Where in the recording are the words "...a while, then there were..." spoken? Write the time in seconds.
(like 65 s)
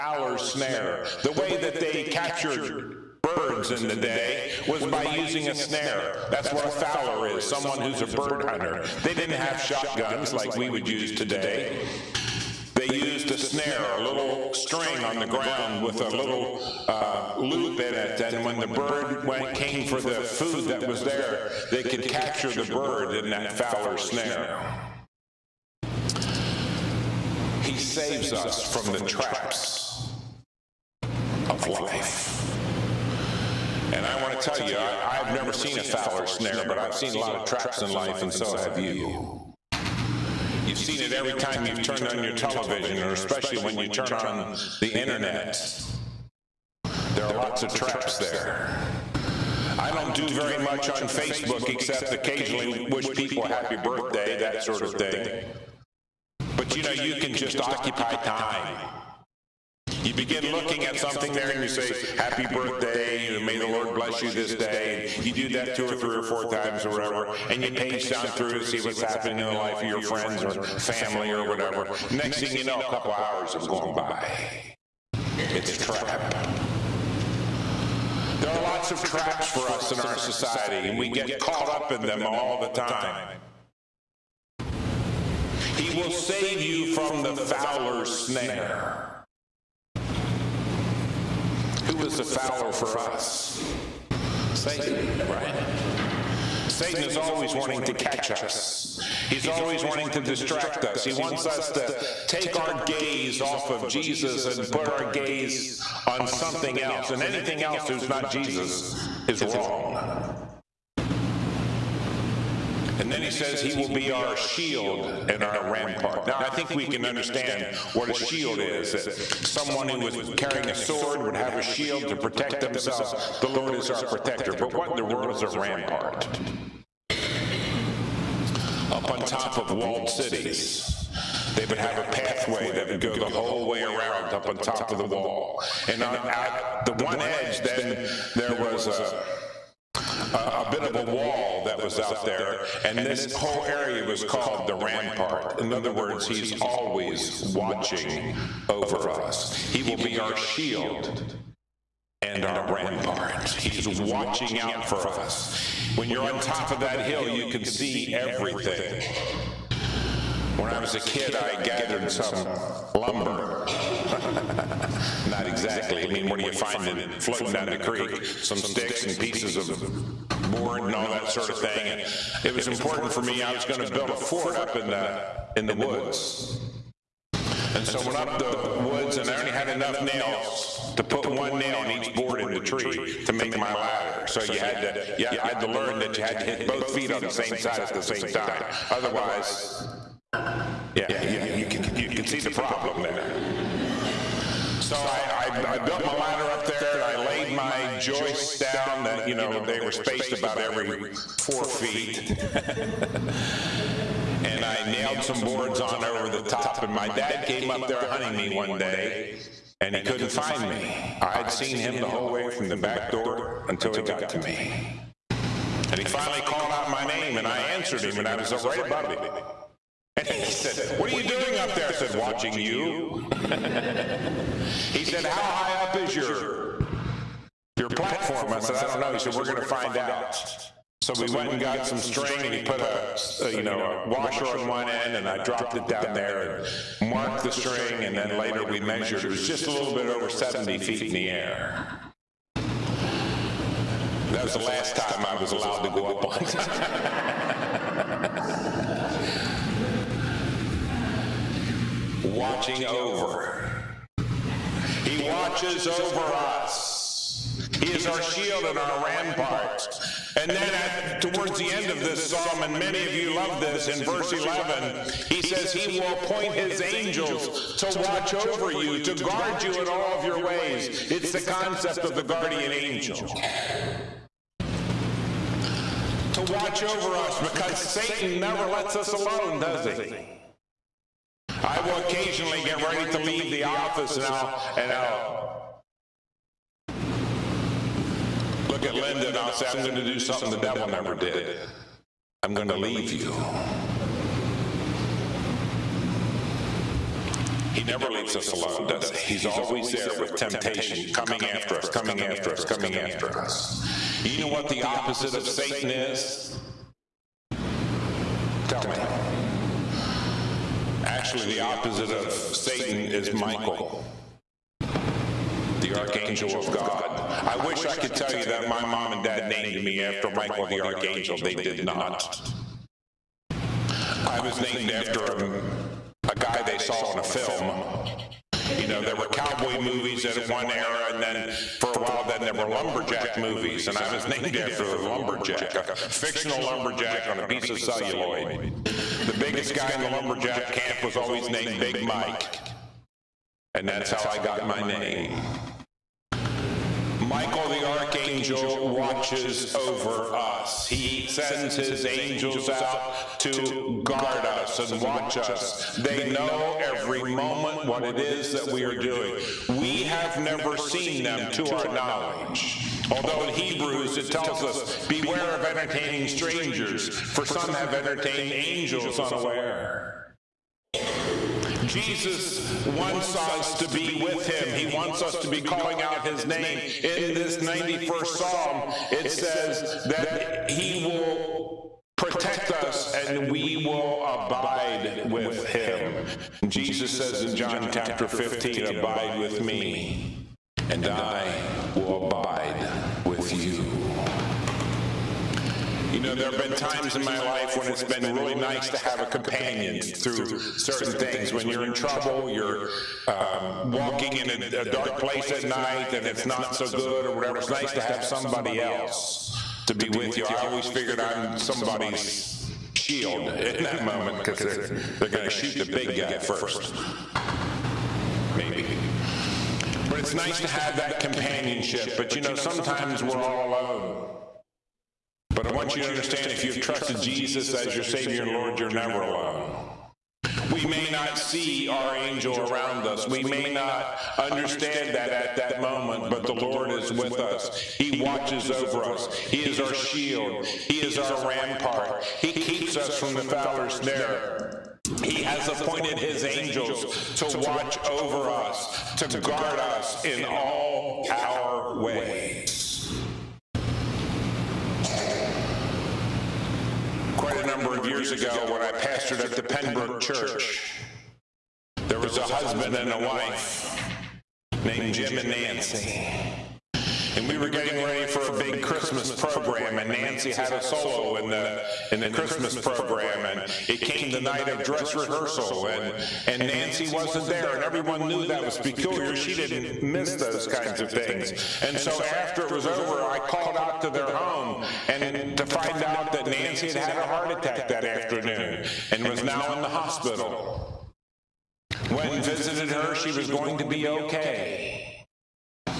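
331 s.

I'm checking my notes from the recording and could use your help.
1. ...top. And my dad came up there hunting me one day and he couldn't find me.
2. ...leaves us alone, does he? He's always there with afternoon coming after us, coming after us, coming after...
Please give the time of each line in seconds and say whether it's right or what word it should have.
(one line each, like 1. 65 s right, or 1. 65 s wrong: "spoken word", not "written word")
1. 206 s right
2. 298 s wrong: "temptation", not "afternoon".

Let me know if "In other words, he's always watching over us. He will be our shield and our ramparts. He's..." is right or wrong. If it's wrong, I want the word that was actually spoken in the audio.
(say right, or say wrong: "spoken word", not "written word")
right.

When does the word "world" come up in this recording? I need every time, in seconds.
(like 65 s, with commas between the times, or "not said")
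125 s.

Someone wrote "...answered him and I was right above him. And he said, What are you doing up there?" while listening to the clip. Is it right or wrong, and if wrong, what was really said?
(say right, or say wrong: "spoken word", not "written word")
right.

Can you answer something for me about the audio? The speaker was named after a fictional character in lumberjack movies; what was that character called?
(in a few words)
Big Mike.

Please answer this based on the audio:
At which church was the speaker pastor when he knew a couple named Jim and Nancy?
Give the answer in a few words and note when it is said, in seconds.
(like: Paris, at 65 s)
Penbrook Church, at 459 s.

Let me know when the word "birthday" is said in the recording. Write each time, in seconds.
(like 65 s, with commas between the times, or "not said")
53 s, 62 s.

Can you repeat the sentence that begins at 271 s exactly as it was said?
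It's the concept of the guardian angel to watch over us because Satan never lets us alone, does he?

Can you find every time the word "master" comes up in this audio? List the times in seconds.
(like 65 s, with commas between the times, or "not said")
not said.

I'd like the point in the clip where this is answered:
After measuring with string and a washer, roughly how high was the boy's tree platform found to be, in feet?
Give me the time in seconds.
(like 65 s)
240 s.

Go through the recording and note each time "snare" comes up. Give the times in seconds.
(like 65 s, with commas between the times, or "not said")
0 s, 5 s, 13 s, 24 s, 36 s, 88 s, 443 s.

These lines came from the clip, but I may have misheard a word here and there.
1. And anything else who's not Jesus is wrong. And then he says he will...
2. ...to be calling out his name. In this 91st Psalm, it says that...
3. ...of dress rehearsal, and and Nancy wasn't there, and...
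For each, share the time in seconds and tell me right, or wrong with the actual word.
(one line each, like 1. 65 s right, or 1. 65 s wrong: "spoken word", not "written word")
1. 107 s right
2. 375 s right
3. 474 s right.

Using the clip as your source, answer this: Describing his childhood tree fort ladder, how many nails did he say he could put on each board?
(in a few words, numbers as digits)
1.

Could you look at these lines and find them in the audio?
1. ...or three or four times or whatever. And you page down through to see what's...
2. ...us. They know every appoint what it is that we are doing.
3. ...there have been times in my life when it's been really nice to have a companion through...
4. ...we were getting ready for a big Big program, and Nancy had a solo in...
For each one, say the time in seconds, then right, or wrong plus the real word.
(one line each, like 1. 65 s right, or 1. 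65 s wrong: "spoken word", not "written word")
1. 65 s right
2. 355 s wrong: "moment", not "appoint"
3. 396 s right
4. 467 s wrong: "Christmas", not "Big".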